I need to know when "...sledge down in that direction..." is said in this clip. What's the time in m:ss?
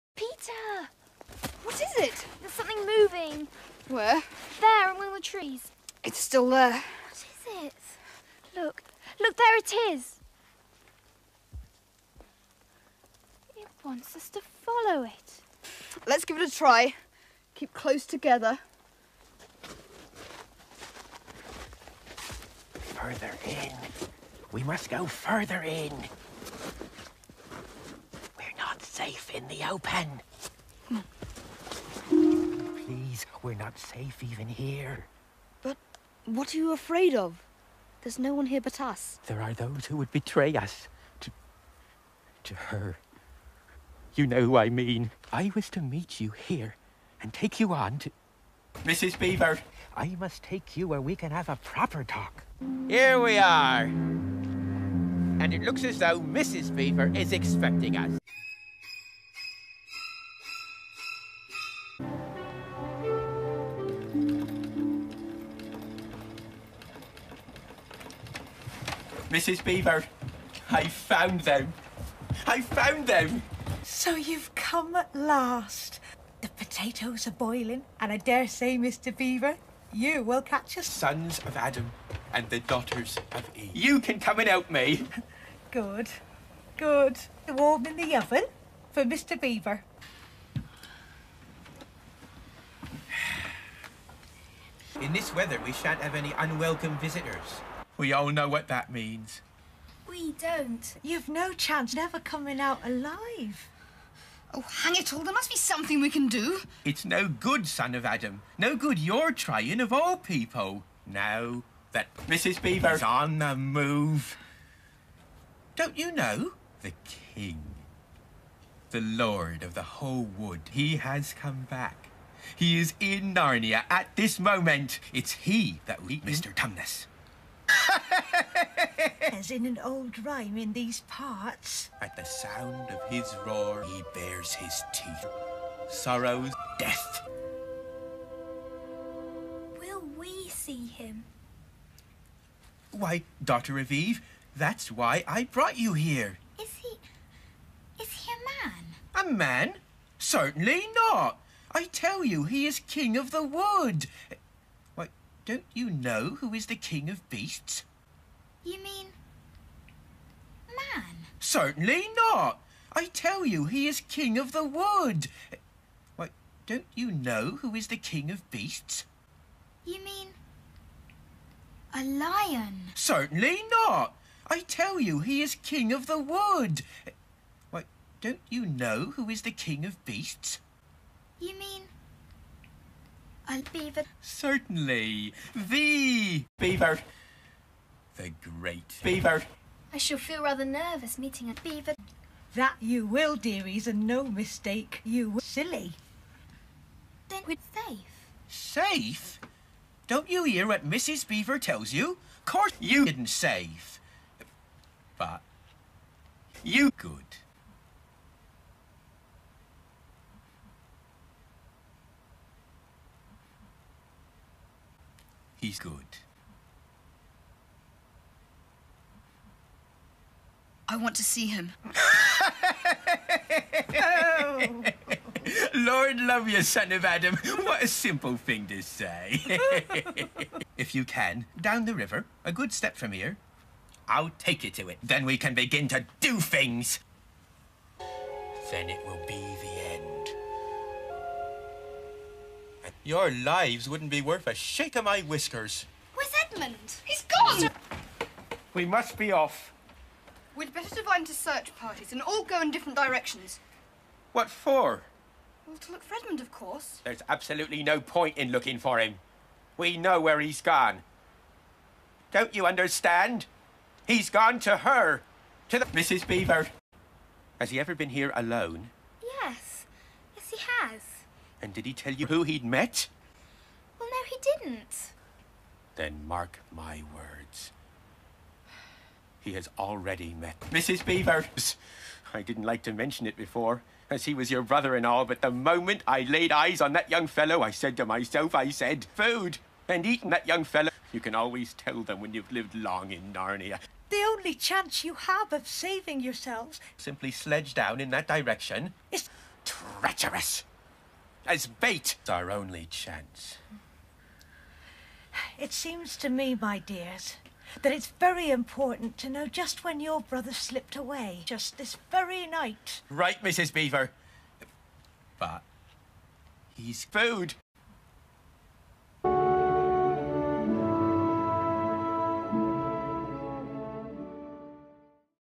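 4:57.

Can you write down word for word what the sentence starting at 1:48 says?
No good you're trying, of all people.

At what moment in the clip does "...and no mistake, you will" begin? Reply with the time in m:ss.
3:13.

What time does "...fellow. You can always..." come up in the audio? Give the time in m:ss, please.
4:50.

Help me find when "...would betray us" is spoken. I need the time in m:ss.
0:39.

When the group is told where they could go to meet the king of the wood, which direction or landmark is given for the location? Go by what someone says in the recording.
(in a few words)
Down the river.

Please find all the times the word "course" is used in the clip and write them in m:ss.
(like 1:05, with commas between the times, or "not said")
3:22, 4:16.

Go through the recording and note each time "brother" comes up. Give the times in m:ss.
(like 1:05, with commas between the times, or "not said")
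4:44, 5:10.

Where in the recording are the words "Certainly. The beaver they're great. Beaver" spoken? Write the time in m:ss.
3:04.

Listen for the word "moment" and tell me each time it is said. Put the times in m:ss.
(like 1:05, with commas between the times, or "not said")
2:04, 4:45.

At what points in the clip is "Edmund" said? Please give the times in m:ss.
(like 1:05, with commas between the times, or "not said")
4:06, 4:16.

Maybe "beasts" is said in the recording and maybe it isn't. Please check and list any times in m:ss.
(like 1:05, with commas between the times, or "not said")
2:37, 2:48, 3:00.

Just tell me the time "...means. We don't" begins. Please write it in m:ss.
1:38.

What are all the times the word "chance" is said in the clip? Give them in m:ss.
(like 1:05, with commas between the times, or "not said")
1:41, 4:54, 5:02.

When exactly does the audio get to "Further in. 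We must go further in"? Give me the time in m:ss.
0:22.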